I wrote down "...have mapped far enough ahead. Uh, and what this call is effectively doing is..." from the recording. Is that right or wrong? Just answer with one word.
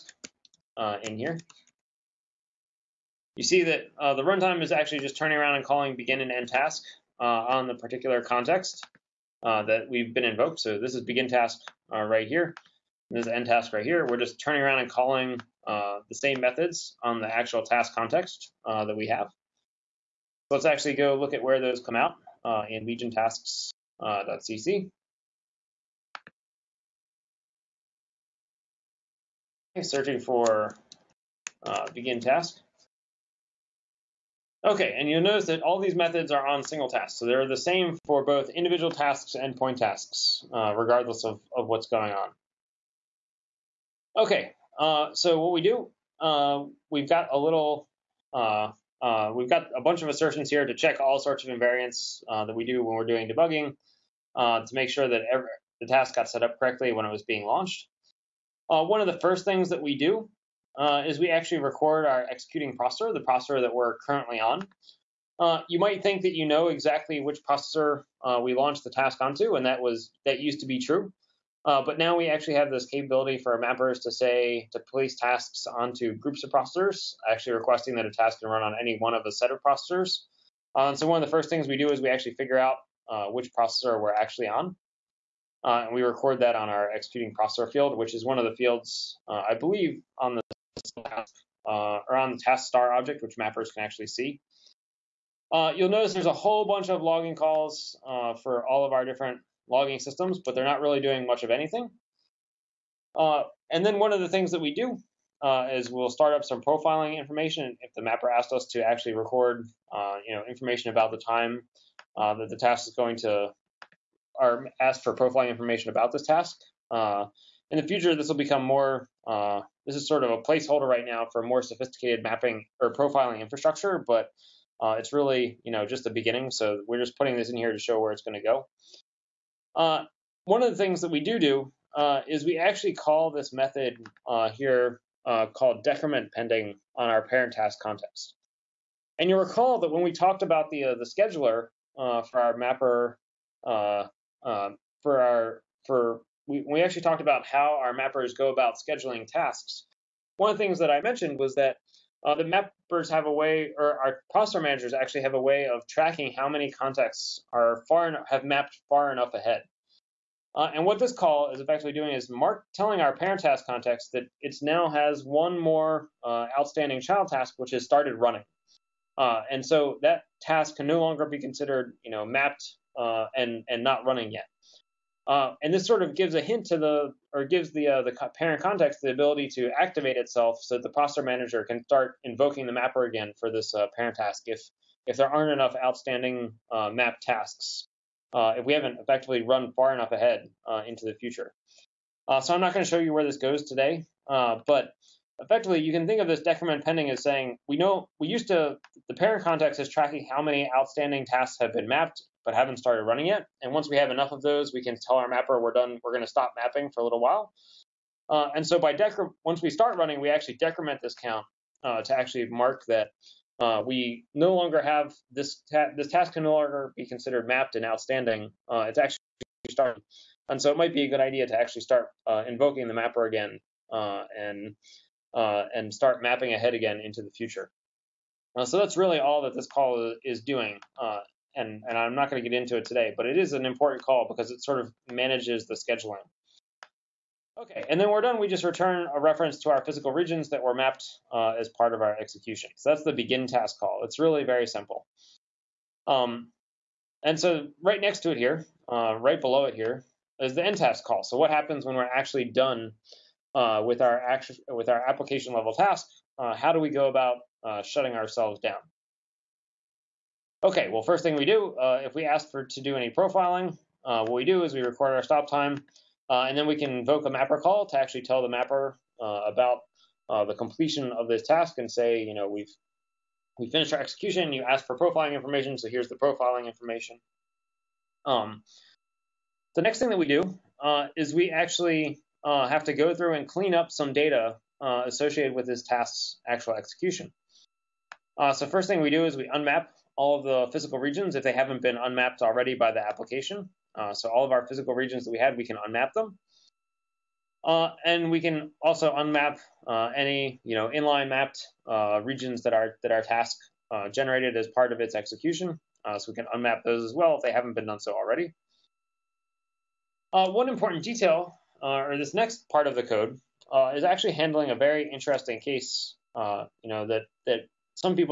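right.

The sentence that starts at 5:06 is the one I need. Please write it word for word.
Uh, so we can unmap those as well if they haven't been done so already.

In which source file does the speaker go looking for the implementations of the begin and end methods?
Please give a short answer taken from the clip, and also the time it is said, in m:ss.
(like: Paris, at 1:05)
legiontasks.cc, at 0:22.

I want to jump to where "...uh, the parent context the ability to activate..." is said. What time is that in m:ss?
2:57.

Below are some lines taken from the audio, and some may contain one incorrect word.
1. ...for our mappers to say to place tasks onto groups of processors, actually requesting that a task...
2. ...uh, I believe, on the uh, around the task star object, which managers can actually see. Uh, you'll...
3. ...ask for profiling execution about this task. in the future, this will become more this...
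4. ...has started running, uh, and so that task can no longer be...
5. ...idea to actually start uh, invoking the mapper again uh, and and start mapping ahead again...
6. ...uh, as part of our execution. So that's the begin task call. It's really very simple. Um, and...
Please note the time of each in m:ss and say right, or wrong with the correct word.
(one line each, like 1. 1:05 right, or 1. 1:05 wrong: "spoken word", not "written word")
1. 1:13 right
2. 1:29 wrong: "mappers", not "managers"
3. 1:54 wrong: "information", not "execution"
4. 2:47 right
5. 3:41 right
6. 4:01 right.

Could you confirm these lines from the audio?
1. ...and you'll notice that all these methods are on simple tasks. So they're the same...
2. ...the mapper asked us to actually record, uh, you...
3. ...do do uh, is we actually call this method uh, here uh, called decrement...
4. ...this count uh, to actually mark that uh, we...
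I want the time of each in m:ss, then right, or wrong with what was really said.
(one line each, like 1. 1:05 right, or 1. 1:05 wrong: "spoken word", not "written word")
1. 0:34 wrong: "single", not "simple"
2. 1:47 right
3. 2:11 right
4. 3:31 right.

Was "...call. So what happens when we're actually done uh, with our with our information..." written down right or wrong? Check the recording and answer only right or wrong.
wrong.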